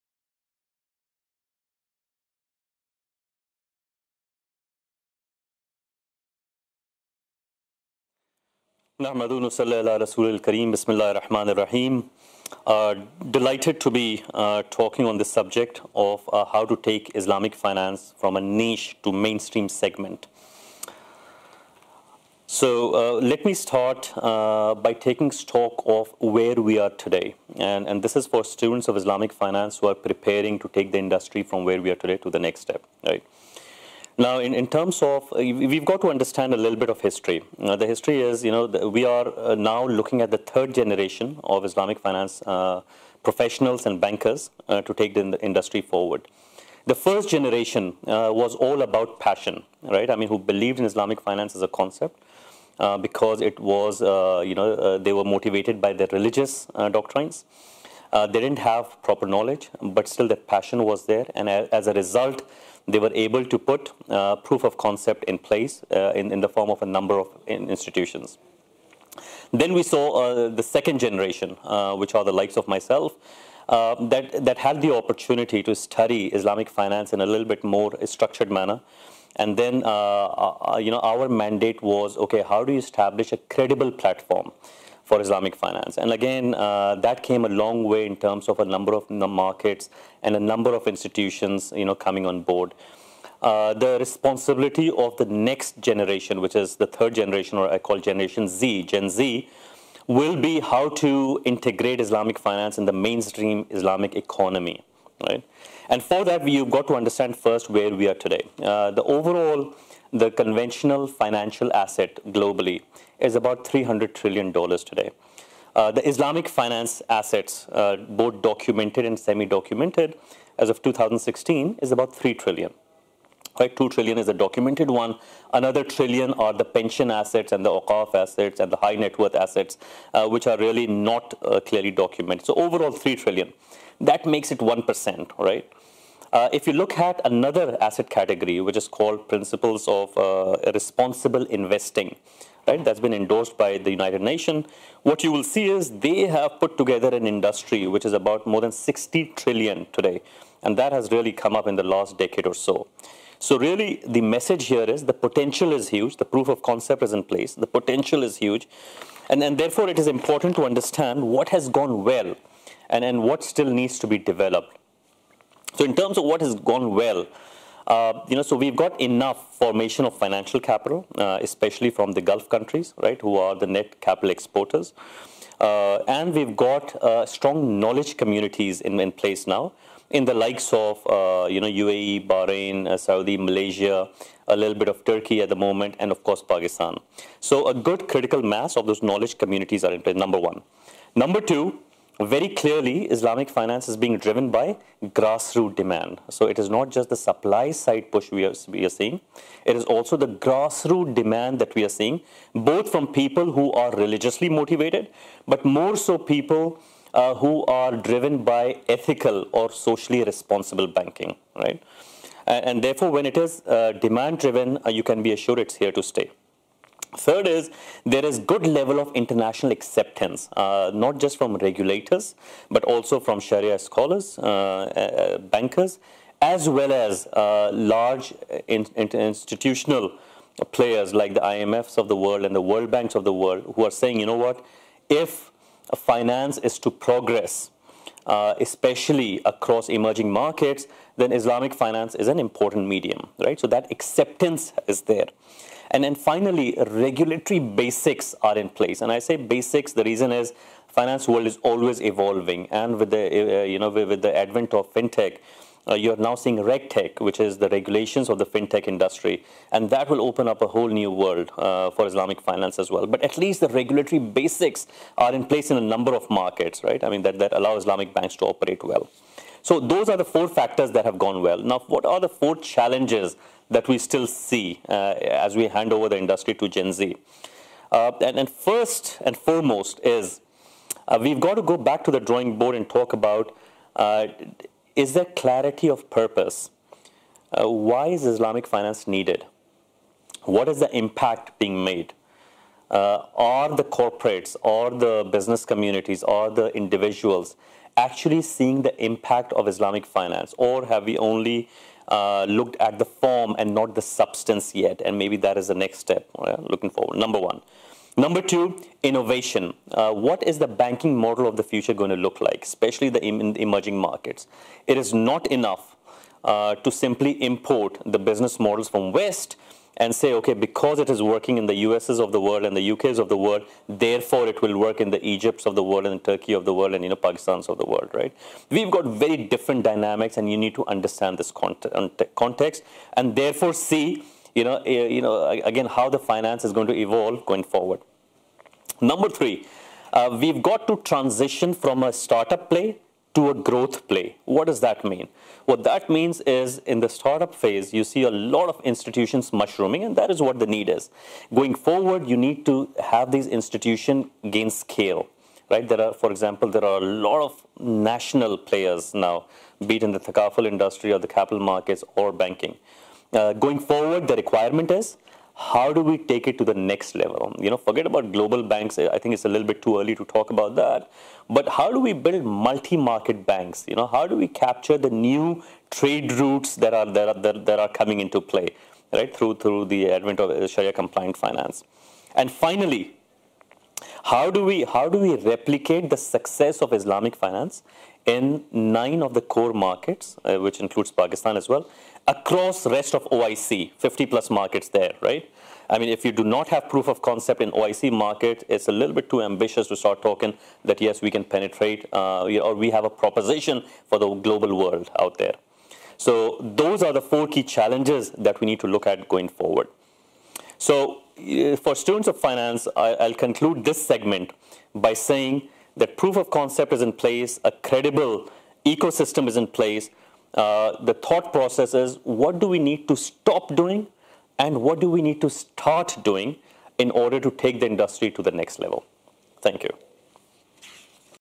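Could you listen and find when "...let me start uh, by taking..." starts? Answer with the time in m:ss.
0:23.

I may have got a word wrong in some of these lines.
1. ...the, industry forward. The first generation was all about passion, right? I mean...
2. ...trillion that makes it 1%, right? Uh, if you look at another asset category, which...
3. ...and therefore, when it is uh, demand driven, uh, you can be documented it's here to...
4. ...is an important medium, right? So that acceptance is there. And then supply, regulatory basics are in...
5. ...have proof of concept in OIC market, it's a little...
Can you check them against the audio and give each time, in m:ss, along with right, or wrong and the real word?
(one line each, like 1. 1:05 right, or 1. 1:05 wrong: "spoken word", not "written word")
1. 0:45 right
2. 2:13 right
3. 3:32 wrong: "assured", not "documented"
4. 4:02 wrong: "finally", not "supply"
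5. 6:36 right.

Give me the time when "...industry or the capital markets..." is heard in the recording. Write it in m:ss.
6:00.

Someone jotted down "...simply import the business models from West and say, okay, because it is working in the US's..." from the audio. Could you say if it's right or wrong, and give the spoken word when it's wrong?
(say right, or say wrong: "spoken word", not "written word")
right.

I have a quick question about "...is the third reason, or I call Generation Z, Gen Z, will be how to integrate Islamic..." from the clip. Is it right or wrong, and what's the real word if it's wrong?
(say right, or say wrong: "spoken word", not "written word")
wrong: "generation", not "reason".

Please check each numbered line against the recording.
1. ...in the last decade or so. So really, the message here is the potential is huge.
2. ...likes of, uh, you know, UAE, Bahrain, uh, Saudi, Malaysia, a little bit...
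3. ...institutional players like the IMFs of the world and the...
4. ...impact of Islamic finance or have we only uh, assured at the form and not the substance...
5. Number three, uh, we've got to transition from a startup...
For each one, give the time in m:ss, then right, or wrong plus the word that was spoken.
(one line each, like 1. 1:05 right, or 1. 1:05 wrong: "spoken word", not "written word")
1. 2:31 right
2. 3:00 right
3. 3:48 right
4. 4:59 wrong: "looked", not "assured"
5. 5:39 right.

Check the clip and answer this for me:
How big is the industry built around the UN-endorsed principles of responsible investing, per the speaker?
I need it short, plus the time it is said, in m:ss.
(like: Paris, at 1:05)
more than 60 trillion, at 2:28.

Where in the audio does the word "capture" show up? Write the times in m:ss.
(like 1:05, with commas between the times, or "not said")
6:14.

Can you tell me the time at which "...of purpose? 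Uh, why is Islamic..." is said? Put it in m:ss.
4:45.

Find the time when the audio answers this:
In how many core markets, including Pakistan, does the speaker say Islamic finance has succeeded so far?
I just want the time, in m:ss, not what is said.
6:28.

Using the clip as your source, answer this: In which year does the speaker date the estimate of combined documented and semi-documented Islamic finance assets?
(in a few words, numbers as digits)
2016.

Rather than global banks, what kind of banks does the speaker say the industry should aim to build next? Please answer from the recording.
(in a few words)
multi-market banks.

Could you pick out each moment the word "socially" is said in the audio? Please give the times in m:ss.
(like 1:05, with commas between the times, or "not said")
3:29.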